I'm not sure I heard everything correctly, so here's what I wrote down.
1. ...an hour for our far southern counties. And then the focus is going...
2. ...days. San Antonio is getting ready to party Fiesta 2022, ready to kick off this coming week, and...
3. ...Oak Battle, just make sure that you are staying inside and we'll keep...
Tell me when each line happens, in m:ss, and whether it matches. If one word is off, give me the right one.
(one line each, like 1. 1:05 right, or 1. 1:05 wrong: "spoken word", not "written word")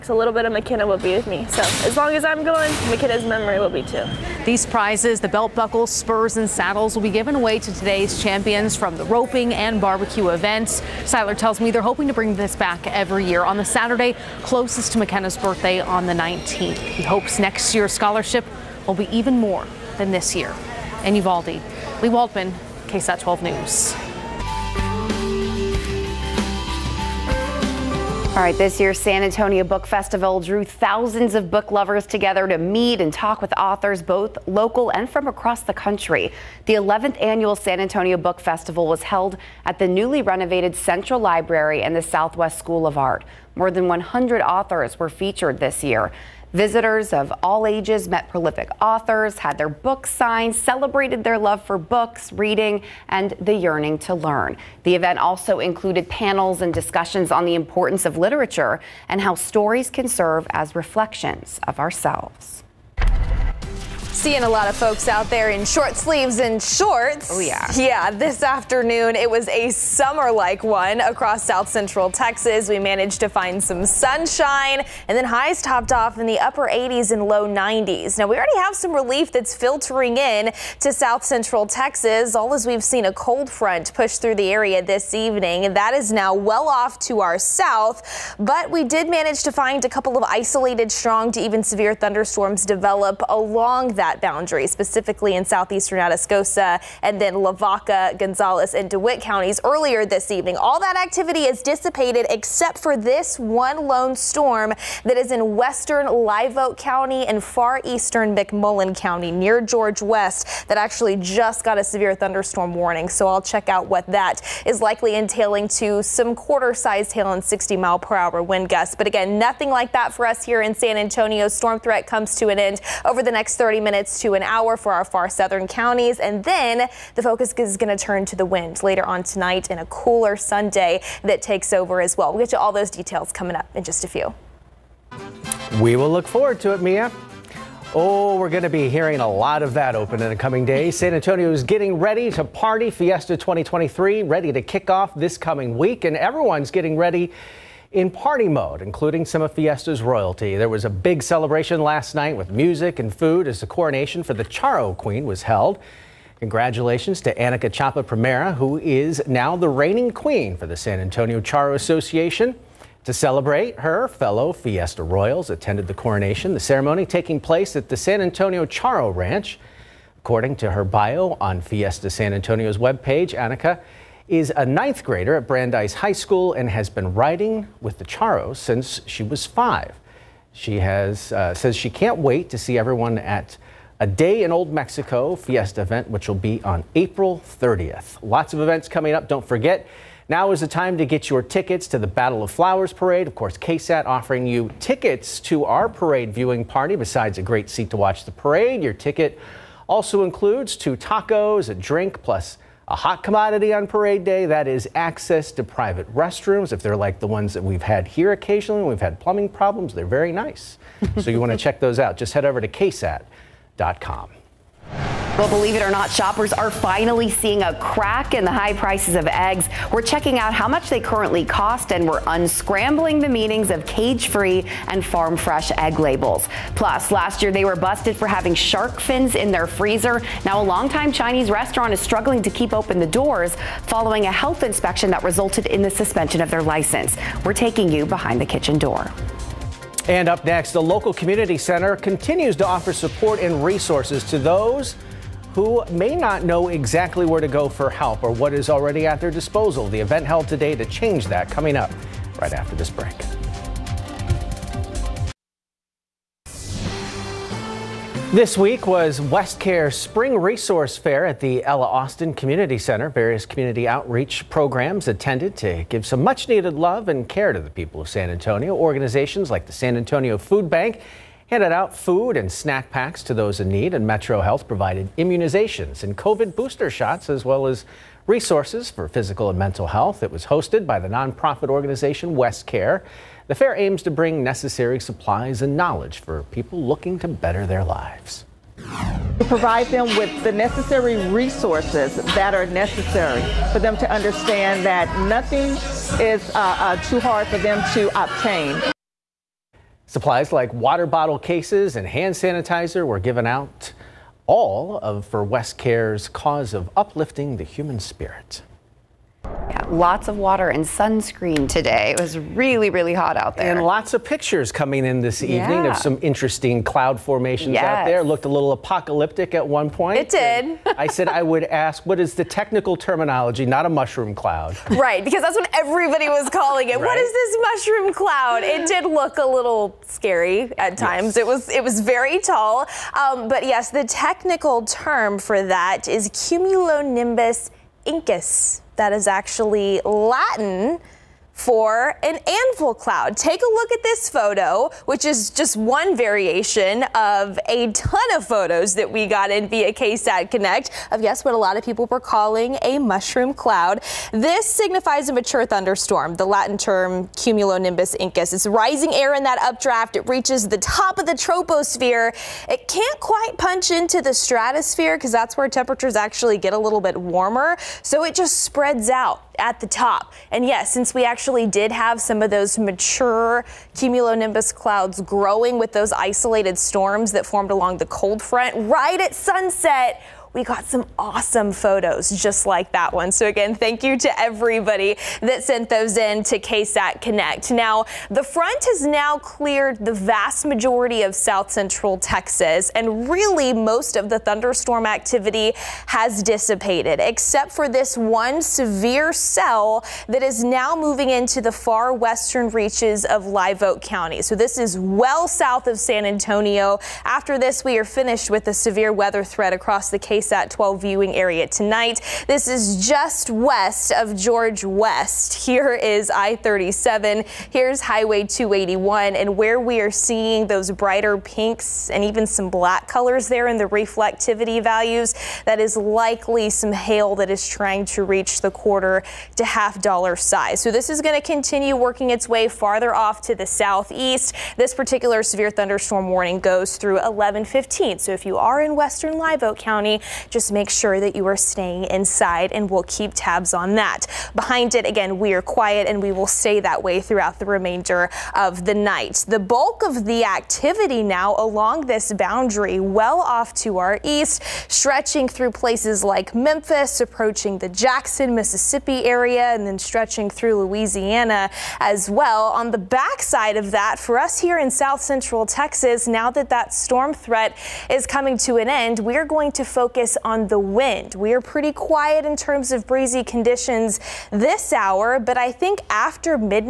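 1. 2:04 right
2. 2:20 wrong: "2023", not "2022"
3. 7:19 wrong: "County", not "Battle".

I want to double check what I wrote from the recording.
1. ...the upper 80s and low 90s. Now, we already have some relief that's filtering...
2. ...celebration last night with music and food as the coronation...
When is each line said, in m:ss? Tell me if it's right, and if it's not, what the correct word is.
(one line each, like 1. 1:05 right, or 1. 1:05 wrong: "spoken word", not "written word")
1. 1:16 right
2. 2:31 right.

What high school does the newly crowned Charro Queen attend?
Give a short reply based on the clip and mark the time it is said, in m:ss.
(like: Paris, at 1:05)
Brandeis High School, at 2:55.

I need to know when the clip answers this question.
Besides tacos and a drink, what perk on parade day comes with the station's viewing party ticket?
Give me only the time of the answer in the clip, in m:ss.
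3:25.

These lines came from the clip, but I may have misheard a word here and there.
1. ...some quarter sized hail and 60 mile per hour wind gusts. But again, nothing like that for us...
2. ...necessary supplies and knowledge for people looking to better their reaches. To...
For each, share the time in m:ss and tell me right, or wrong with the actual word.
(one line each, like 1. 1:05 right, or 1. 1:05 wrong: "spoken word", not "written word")
1. 1:56 right
2. 4:44 wrong: "lives", not "reaches".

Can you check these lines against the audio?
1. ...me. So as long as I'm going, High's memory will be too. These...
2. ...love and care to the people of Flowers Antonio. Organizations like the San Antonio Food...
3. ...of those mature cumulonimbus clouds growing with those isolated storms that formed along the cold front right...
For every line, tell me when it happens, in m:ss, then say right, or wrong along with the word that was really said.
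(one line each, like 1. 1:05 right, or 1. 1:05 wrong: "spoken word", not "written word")
1. 0:01 wrong: "Makenna", not "High"
2. 4:26 wrong: "San", not "Flowers"
3. 6:12 right.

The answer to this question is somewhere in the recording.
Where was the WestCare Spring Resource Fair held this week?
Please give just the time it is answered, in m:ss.
4:21.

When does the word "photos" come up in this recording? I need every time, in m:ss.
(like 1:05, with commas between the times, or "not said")
5:44, 5:48, 6:21.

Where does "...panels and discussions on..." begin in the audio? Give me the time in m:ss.
0:56.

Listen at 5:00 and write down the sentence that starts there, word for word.
Supplies like water bottle cases and hand sanitizer were given out, all of for WestCare's cause of uplifting the human spirit.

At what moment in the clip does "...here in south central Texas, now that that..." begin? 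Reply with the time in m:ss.
7:44.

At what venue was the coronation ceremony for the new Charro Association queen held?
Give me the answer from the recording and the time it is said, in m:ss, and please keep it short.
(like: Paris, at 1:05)
San Antonio Charro Ranch, at 2:47.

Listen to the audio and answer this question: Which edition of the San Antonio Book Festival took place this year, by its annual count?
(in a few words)
11th.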